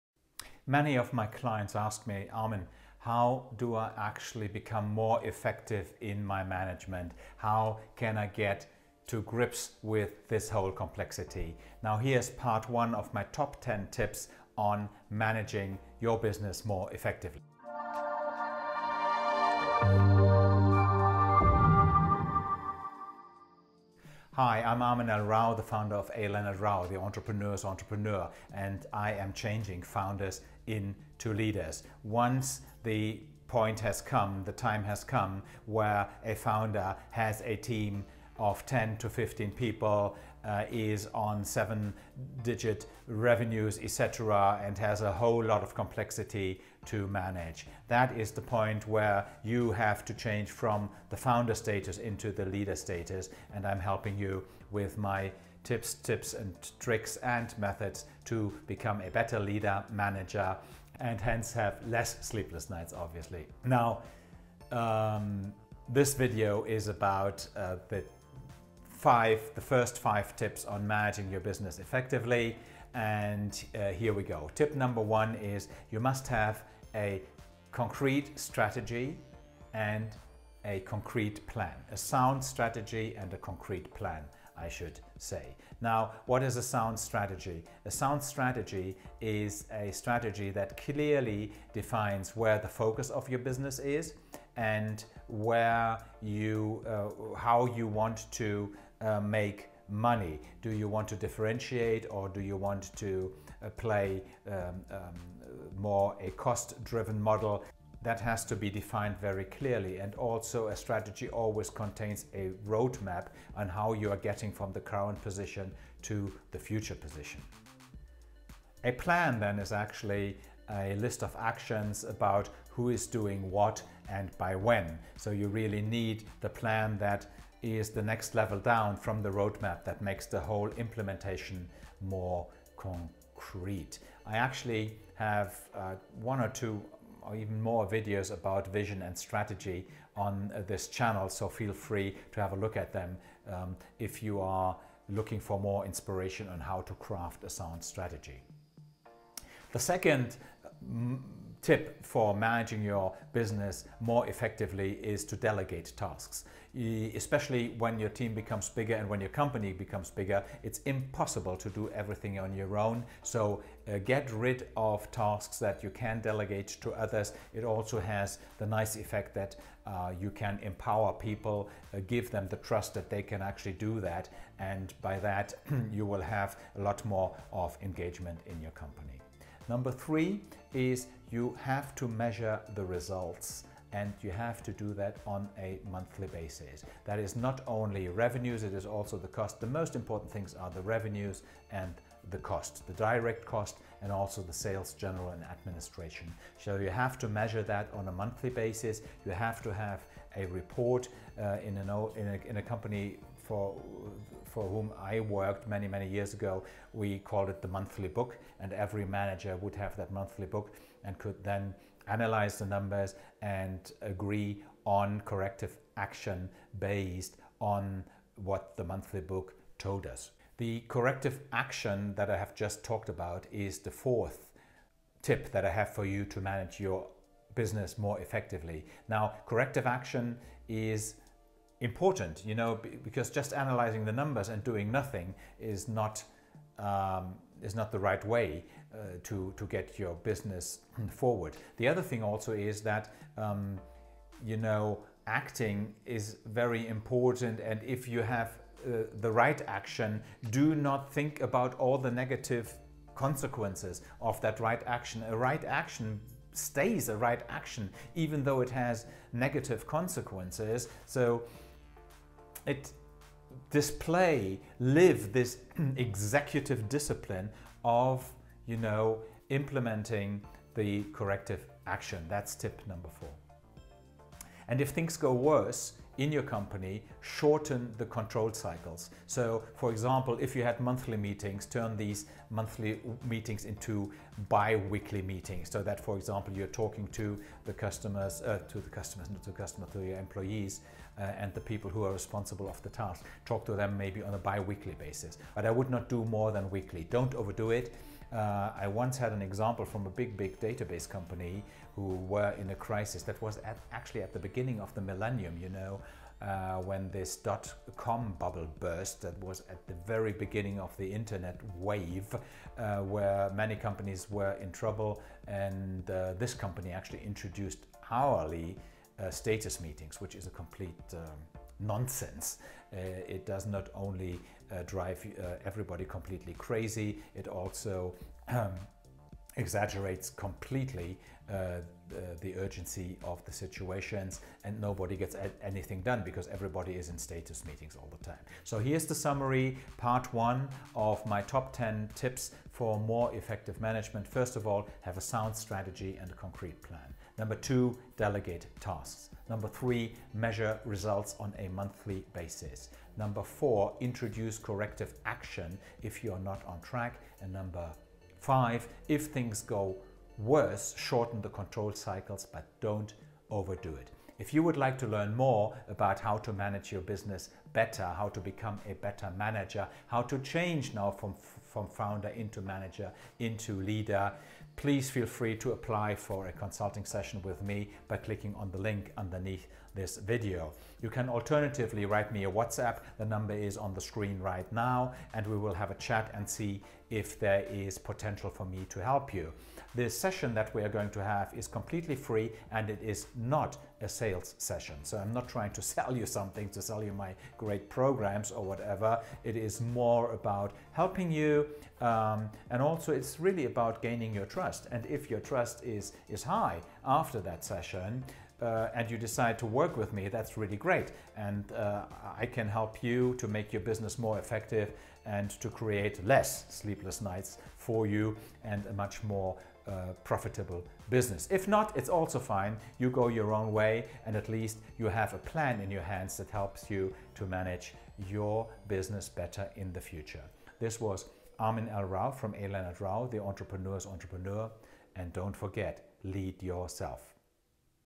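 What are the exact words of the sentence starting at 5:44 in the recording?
First of all, have a sound strategy and a concrete plan.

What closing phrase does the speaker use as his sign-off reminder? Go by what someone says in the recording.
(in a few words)
lead yourself.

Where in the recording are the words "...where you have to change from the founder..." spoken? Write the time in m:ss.
0:48.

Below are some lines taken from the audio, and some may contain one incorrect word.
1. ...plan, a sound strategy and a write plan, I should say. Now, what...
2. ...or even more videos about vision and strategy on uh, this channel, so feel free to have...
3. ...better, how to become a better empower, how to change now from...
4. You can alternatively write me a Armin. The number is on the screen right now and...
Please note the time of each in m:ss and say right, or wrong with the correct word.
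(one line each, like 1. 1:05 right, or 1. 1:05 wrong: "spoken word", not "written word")
1. 1:21 wrong: "concrete", not "write"
2. 2:17 right
3. 6:07 wrong: "manager", not "empower"
4. 6:21 wrong: "WhatsApp", not "Armin".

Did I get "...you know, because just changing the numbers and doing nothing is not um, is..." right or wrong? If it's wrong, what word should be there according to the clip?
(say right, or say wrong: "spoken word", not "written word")
wrong: "analyzing", not "changing".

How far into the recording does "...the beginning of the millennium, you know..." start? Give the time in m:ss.
5:04.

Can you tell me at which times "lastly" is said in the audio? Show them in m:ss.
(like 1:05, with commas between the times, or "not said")
not said.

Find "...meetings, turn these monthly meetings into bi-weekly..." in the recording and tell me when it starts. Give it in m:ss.
4:41.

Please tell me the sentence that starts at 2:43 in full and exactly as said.
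So uh, get rid of tasks that you can delegate to others.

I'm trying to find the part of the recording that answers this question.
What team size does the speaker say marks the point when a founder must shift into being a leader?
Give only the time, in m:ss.
0:38.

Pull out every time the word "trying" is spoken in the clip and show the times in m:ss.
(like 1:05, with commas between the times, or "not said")
6:35.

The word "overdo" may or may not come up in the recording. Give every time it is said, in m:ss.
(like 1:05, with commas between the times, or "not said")
4:57, 6:03.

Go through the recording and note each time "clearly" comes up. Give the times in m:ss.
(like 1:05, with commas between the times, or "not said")
1:30, 1:49.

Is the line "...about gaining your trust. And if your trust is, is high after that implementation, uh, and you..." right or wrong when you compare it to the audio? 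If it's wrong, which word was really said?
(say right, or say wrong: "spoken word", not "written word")
wrong: "session", not "implementation".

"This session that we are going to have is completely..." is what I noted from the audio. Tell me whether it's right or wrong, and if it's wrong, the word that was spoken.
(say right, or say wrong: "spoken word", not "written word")
right.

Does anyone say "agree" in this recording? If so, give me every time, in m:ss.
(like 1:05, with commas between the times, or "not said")
3:34.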